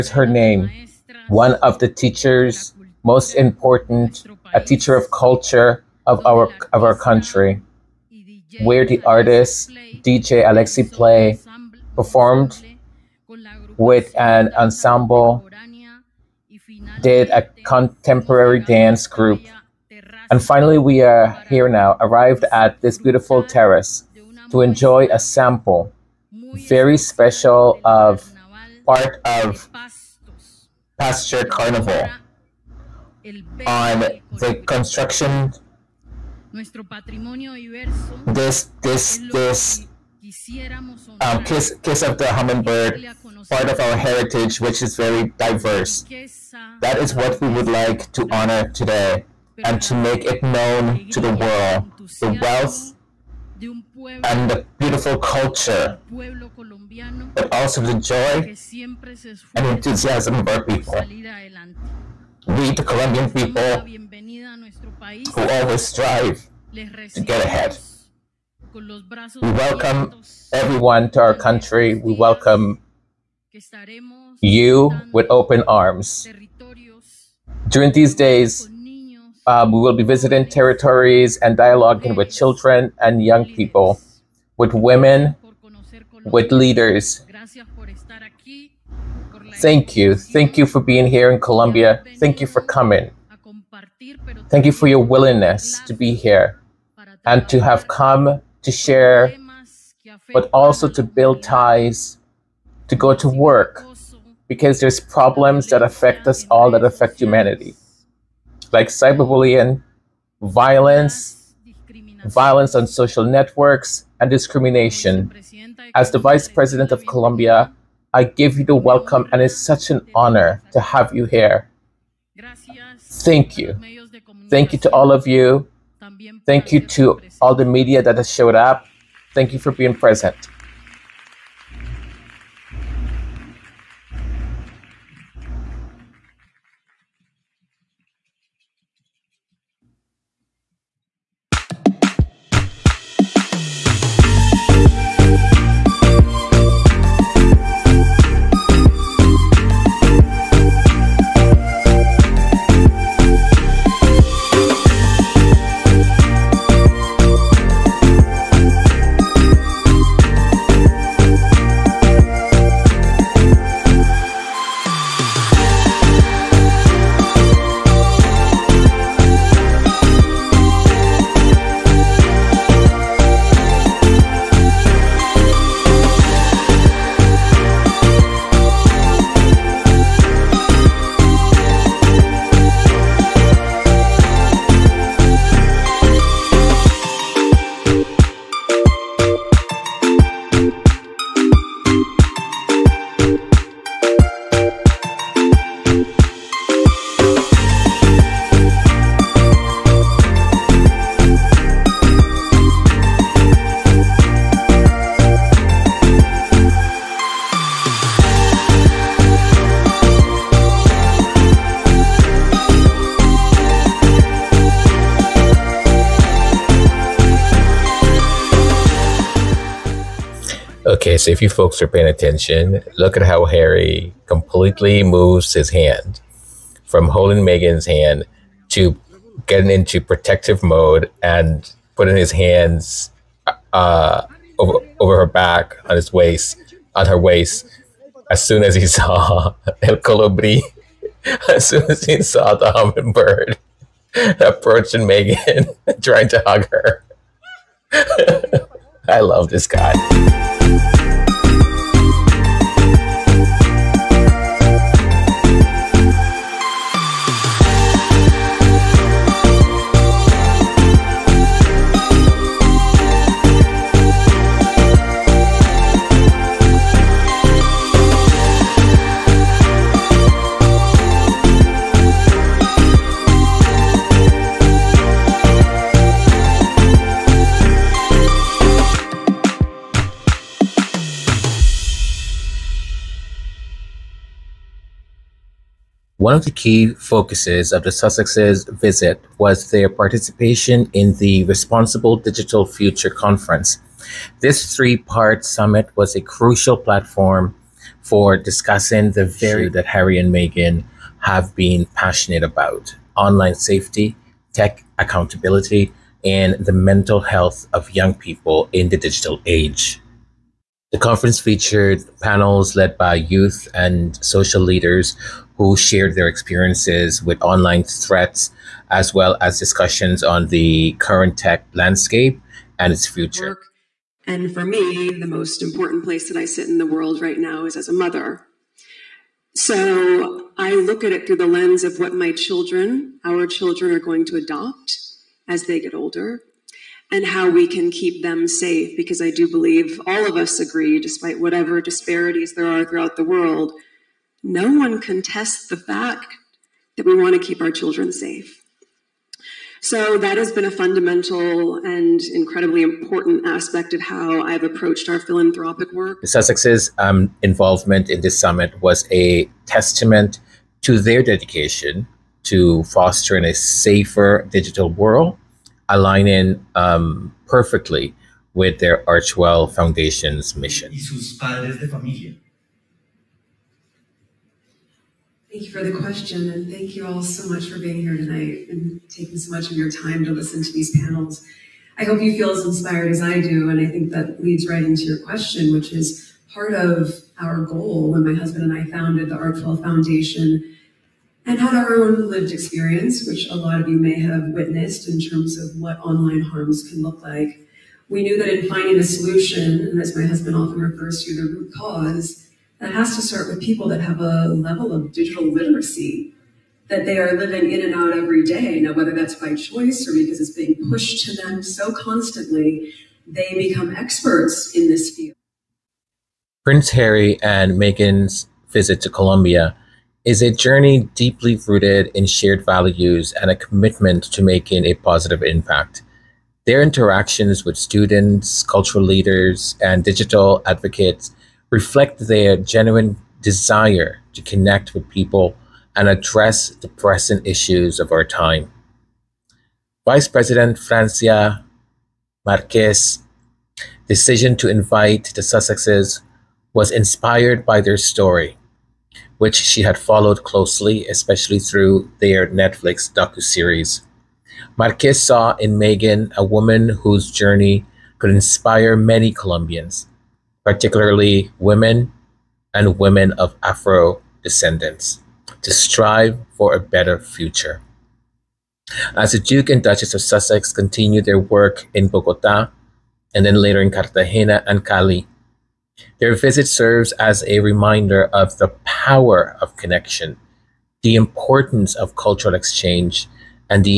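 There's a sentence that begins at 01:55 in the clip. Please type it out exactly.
As the Vice President of Colombia, I give you the welcome, and it's such an honor to have you here.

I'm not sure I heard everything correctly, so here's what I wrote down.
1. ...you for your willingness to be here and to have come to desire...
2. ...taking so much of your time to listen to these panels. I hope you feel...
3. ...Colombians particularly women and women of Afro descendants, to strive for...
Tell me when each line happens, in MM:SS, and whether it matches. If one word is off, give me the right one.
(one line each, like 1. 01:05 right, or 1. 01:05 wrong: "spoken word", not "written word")
1. 01:34 wrong: "share", not "desire"
2. 06:19 right
3. 07:39 right.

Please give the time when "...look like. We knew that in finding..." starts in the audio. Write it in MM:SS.
06:37.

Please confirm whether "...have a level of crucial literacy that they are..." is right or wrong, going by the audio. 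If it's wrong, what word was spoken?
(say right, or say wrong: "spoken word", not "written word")
wrong: "digital", not "crucial".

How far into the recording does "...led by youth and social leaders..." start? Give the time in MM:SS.
05:12.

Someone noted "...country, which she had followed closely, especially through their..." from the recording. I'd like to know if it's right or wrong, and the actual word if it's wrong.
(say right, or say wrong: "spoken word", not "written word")
wrong: "story", not "country".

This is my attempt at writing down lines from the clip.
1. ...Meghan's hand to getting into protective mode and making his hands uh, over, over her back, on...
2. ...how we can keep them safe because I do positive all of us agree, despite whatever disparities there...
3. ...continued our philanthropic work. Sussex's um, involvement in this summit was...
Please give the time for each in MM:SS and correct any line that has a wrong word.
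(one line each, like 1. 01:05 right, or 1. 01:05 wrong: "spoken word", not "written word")
1. 03:47 wrong: "putting", not "making"
2. 05:37 wrong: "believe", not "positive"
3. 05:54 wrong: "approached", not "continued".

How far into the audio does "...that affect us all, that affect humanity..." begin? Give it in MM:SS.
01:45.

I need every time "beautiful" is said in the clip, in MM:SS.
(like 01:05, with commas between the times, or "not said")
00:22, 00:54.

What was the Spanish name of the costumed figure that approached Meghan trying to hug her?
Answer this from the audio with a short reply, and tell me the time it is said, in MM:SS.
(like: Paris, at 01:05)
El Colibri, at 03:59.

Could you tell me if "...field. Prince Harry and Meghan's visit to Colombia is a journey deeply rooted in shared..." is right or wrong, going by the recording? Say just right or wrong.
right.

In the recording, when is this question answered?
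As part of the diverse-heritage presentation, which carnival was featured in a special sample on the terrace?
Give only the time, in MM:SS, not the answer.
00:30.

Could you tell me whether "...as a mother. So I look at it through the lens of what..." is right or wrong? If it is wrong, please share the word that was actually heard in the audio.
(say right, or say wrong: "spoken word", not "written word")
right.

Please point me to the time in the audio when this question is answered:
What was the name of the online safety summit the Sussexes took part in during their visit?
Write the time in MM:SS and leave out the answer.
04:51.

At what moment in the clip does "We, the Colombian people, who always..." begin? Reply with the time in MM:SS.
01:02.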